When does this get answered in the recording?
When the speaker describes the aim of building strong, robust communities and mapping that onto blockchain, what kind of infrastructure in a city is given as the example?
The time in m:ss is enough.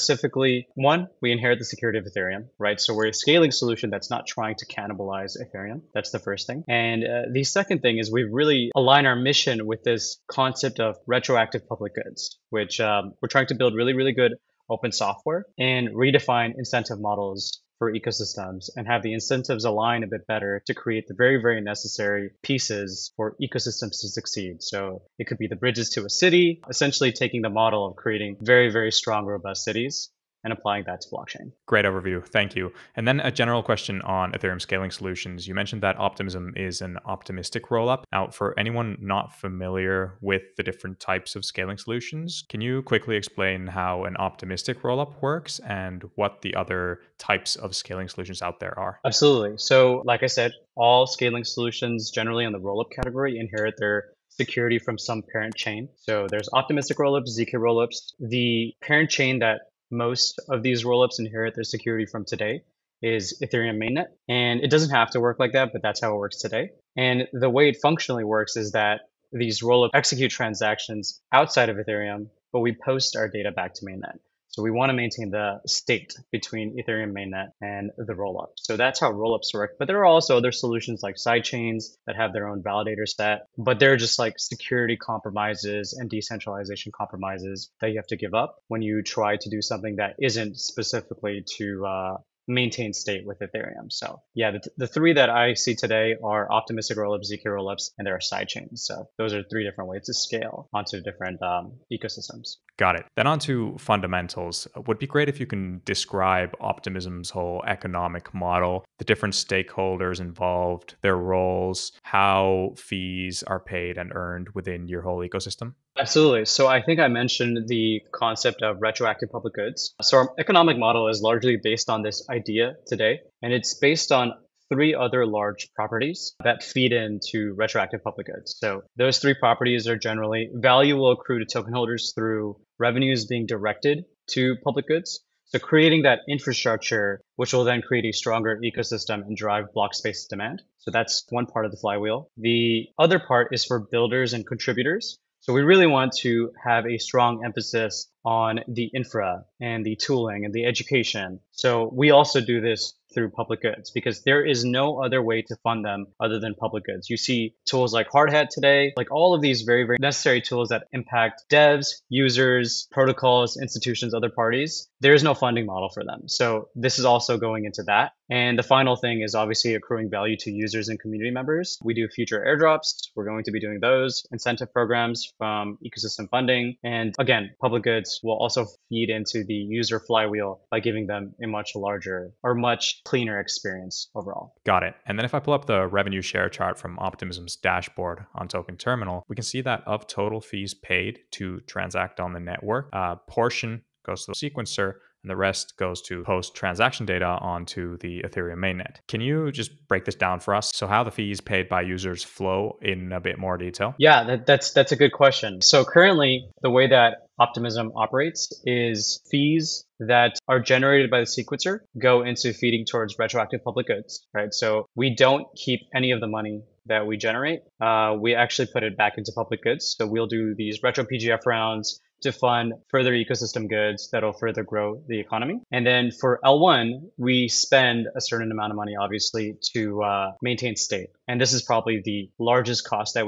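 0:25.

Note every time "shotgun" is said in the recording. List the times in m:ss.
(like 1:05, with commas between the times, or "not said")
not said.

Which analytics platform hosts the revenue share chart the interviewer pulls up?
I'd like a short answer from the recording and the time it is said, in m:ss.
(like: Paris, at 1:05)
Token Terminal, at 3:08.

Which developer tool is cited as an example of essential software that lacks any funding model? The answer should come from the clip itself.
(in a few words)
Hardhat.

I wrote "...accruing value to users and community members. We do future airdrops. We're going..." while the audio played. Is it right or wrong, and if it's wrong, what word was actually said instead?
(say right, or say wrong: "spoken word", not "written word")
right.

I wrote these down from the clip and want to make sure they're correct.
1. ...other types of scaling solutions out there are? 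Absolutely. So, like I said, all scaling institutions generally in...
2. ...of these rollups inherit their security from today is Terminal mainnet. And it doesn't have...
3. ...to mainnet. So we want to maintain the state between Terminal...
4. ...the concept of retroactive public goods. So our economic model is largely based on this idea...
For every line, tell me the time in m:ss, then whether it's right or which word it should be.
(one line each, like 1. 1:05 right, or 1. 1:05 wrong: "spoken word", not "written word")
1. 0:46 wrong: "solutions", not "institutions"
2. 1:00 wrong: "Ethereum", not "Terminal"
3. 1:13 wrong: "Ethereum", not "Terminal"
4. 1:57 right.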